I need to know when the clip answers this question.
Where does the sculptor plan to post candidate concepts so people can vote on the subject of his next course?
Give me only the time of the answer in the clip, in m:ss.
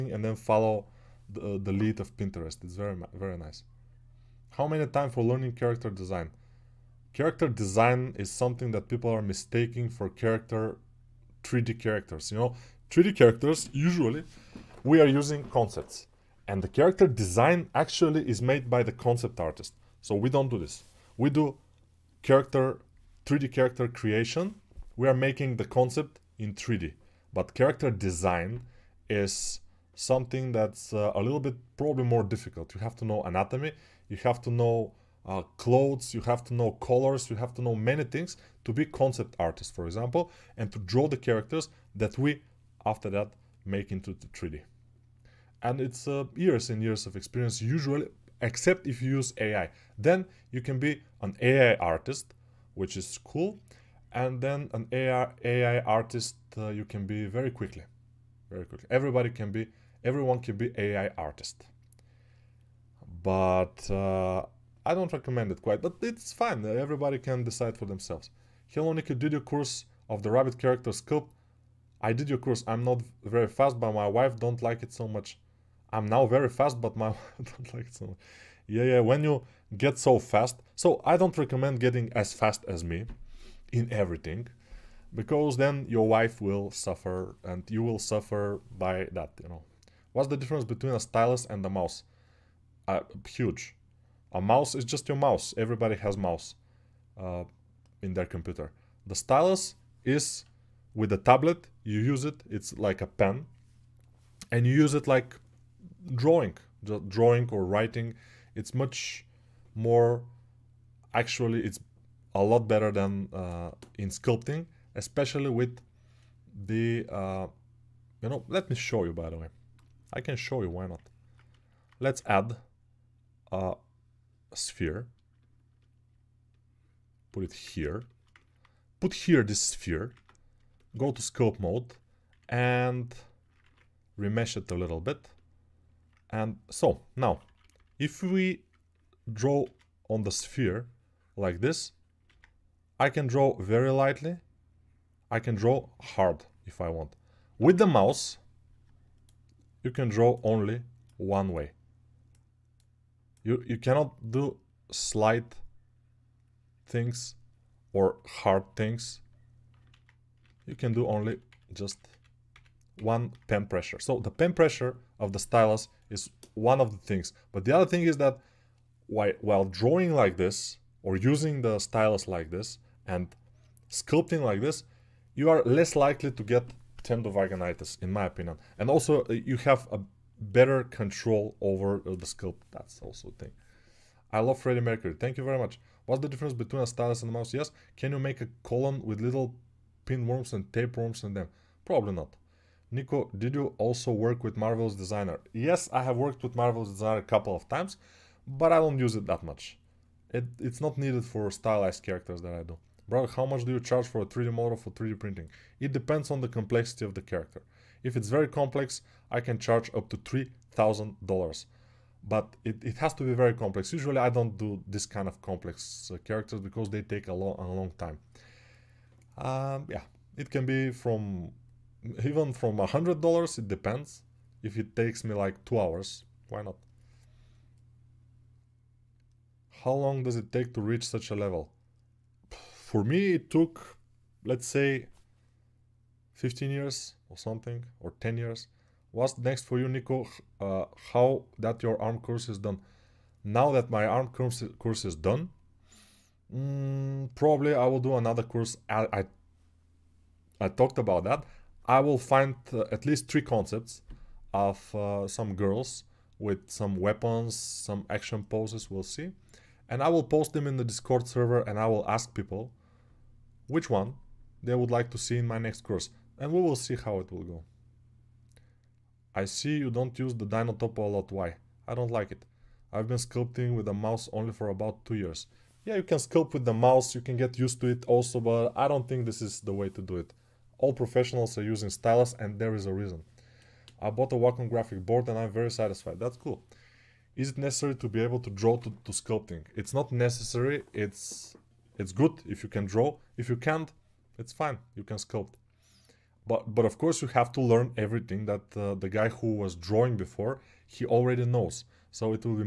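4:20.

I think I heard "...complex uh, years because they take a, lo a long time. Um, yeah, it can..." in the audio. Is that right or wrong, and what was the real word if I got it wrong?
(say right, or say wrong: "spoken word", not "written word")
wrong: "characters", not "years".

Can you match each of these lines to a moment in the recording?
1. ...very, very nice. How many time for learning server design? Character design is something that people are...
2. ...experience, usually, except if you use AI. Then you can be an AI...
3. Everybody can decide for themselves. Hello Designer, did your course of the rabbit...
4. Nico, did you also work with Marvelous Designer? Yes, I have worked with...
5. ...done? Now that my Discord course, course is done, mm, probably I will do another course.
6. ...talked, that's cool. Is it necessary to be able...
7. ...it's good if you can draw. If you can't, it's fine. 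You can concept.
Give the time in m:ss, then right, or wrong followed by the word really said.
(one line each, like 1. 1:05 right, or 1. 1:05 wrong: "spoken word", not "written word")
1. 0:02 wrong: "character", not "server"
2. 0:47 right
3. 1:06 wrong: "Nicky", not "Designer"
4. 3:12 right
5. 4:02 wrong: "ARM", not "Discord"
6. 4:45 wrong: "satisfied", not "talked"
7. 4:51 wrong: "sculpt", not "concept".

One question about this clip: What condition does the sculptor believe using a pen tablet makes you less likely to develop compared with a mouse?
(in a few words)
Tendovaginitis.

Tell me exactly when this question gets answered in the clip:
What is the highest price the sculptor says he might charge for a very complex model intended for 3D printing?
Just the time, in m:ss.
3:30.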